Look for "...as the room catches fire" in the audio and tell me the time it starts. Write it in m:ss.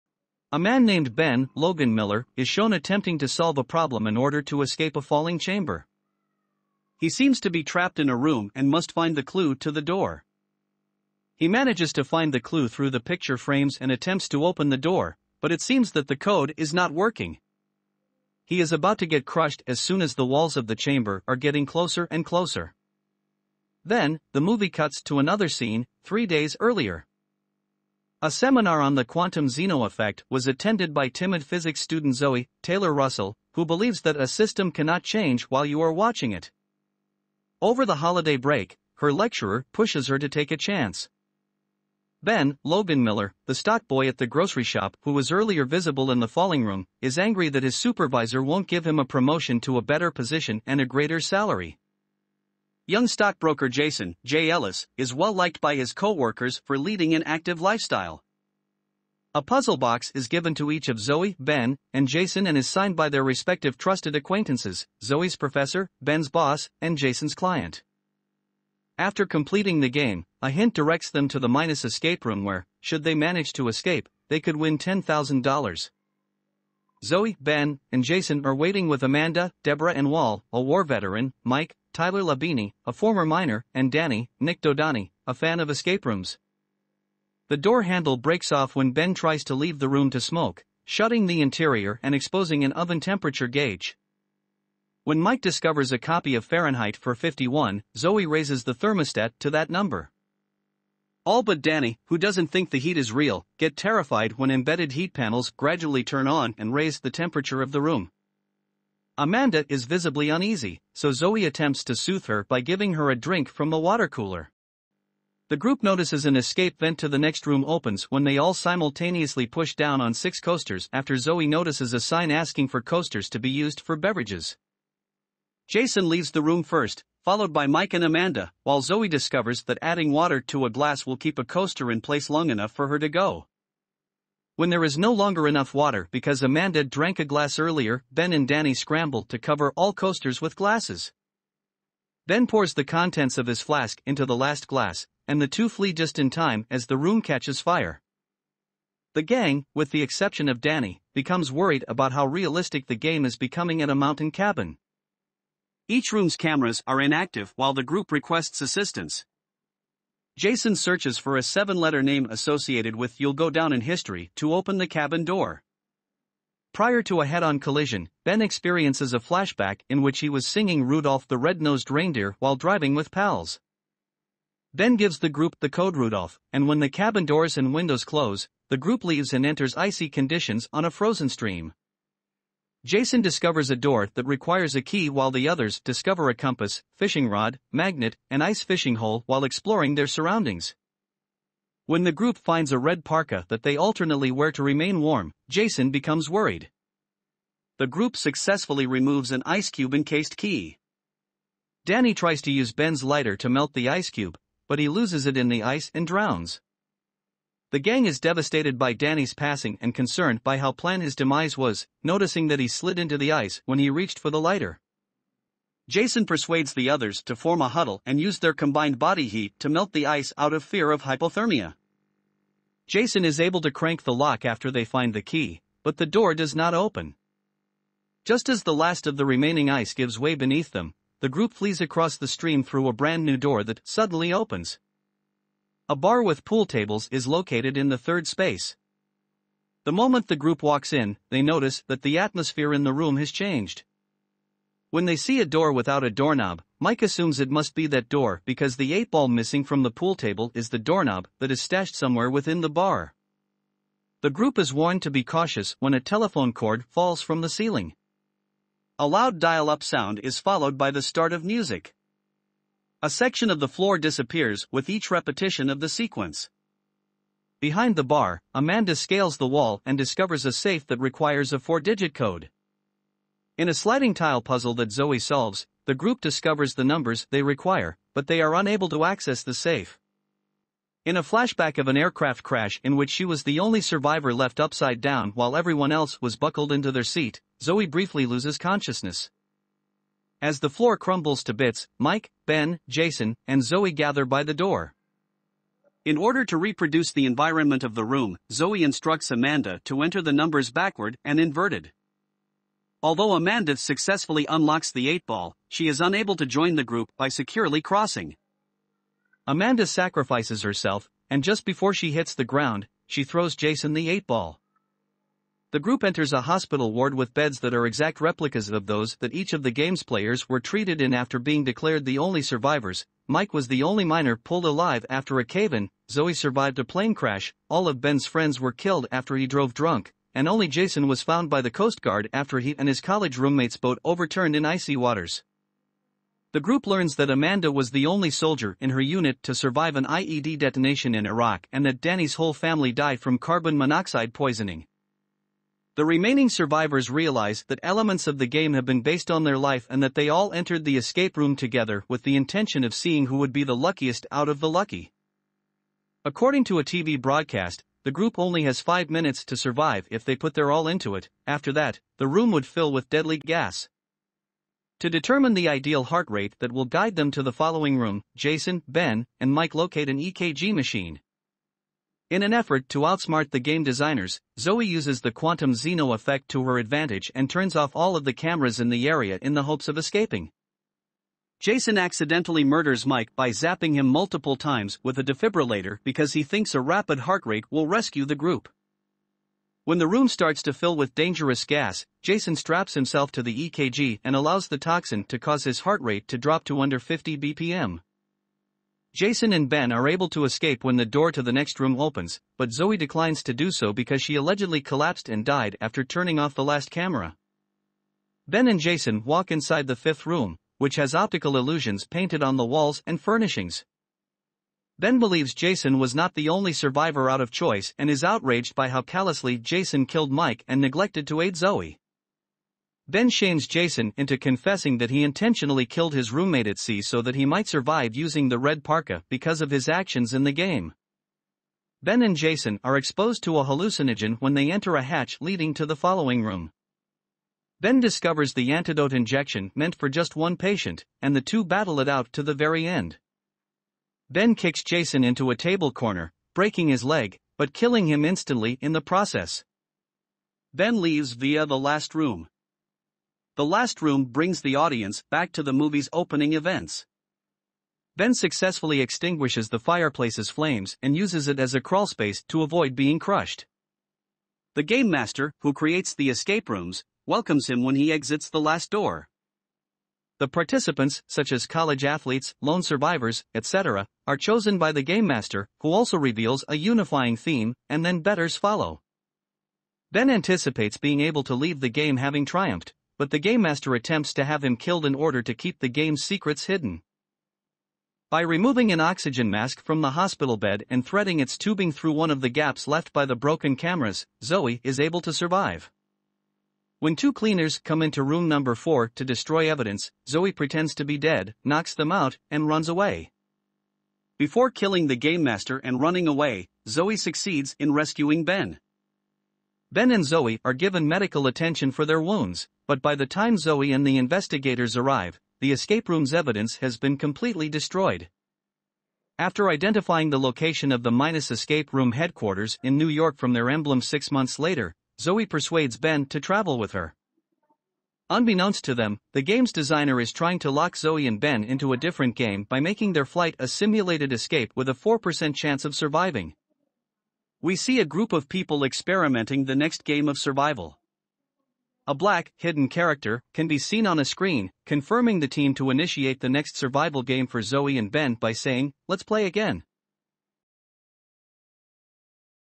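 2:26.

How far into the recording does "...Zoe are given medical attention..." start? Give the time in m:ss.
8:30.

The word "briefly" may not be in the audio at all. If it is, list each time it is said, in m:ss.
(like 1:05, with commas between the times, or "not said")
4:47.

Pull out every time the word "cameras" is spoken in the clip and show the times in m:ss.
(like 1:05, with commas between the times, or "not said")
2:36, 6:18, 6:46, 8:13.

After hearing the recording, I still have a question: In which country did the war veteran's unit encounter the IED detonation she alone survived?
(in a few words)
Iraq.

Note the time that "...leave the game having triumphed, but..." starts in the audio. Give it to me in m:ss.
8:01.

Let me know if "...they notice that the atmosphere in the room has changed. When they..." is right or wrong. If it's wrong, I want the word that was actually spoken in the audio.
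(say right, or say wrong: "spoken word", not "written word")
right.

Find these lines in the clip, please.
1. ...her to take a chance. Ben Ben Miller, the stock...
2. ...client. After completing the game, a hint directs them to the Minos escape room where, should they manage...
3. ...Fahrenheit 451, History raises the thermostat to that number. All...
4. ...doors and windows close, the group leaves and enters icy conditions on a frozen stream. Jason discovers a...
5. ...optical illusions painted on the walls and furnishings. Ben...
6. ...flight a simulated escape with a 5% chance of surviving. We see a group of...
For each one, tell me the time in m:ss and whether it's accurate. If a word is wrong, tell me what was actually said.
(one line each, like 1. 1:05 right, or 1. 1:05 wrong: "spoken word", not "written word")
1. 0:40 wrong: "Logan", not "Ben"
2. 1:07 right
3. 1:36 wrong: "Zoe", not "History"
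4. 2:57 right
5. 6:51 right
6. 8:53 wrong: "4", not "5".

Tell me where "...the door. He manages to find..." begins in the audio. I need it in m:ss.
0:09.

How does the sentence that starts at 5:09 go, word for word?
Amanda sacrifices herself, and just before she hits the ground, she throws Jason the 8-ball.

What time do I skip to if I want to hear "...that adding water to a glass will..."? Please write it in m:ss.
2:09.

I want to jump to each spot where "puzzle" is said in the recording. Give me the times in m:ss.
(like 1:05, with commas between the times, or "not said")
0:59, 4:34.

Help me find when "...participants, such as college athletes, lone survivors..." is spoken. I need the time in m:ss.
7:50.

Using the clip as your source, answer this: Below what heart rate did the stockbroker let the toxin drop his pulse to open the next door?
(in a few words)
50 BPM.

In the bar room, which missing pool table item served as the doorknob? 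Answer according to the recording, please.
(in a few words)
The eight ball.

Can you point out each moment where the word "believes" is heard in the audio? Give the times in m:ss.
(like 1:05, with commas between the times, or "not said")
0:33, 6:55.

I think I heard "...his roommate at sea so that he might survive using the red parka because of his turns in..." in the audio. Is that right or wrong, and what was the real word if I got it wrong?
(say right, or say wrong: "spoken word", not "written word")
wrong: "actions", not "turns".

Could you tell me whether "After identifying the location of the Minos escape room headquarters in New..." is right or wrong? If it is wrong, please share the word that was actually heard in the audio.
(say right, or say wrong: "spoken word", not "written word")
right.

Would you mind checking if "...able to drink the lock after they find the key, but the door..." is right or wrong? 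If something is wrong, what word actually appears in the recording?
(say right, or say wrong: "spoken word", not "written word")
wrong: "crank", not "drink".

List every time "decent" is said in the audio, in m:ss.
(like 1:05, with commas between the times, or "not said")
not said.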